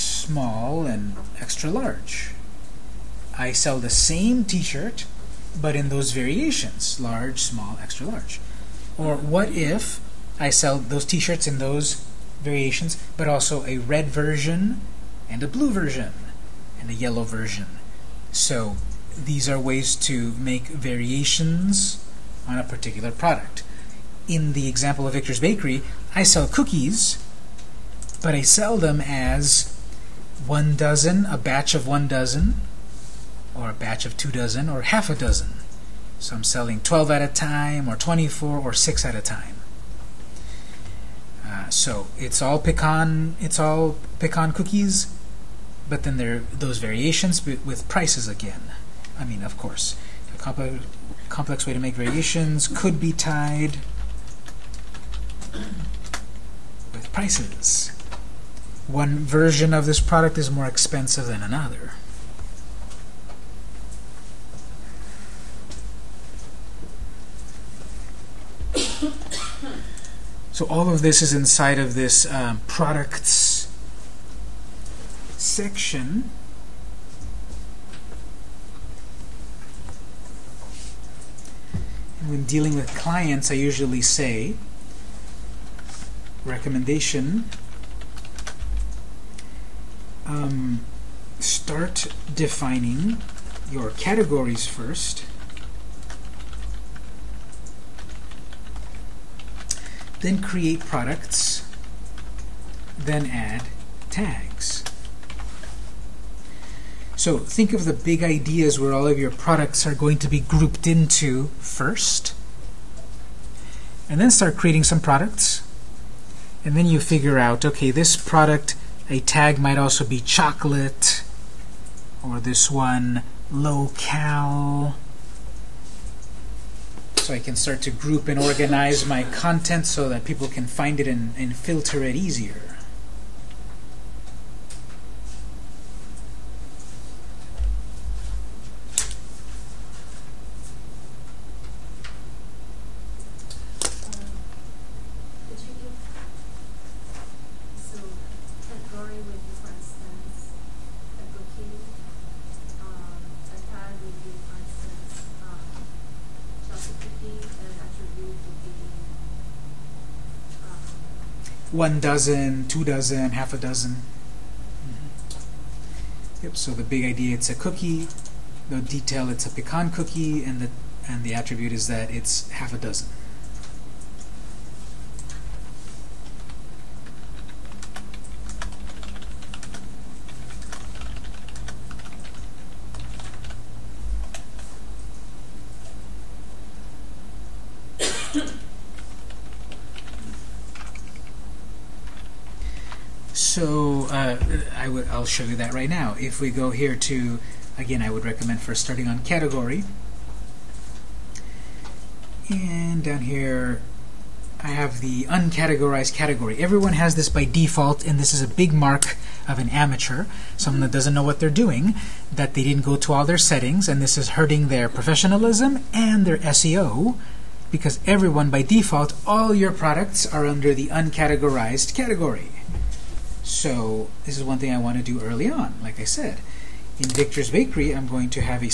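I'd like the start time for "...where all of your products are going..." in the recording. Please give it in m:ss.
1:48.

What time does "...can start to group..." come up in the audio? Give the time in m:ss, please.
2:07.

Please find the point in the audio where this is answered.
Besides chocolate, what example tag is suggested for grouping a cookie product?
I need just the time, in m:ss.
2:03.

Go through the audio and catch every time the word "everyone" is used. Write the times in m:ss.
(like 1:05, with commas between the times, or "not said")
3:26, 3:38.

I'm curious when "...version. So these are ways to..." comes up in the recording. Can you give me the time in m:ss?
0:17.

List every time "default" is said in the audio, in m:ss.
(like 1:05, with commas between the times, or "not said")
3:27, 3:38.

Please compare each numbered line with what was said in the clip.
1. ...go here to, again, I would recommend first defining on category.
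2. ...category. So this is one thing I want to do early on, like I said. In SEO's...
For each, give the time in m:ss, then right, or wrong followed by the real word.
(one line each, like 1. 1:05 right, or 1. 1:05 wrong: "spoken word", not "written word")
1. 3:16 wrong: "starting", not "defining"
2. 3:41 wrong: "Victor", not "SEO".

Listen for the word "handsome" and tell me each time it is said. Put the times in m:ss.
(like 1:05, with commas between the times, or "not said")
not said.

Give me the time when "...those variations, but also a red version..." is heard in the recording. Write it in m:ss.
0:11.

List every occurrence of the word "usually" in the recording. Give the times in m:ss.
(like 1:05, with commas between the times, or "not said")
1:23.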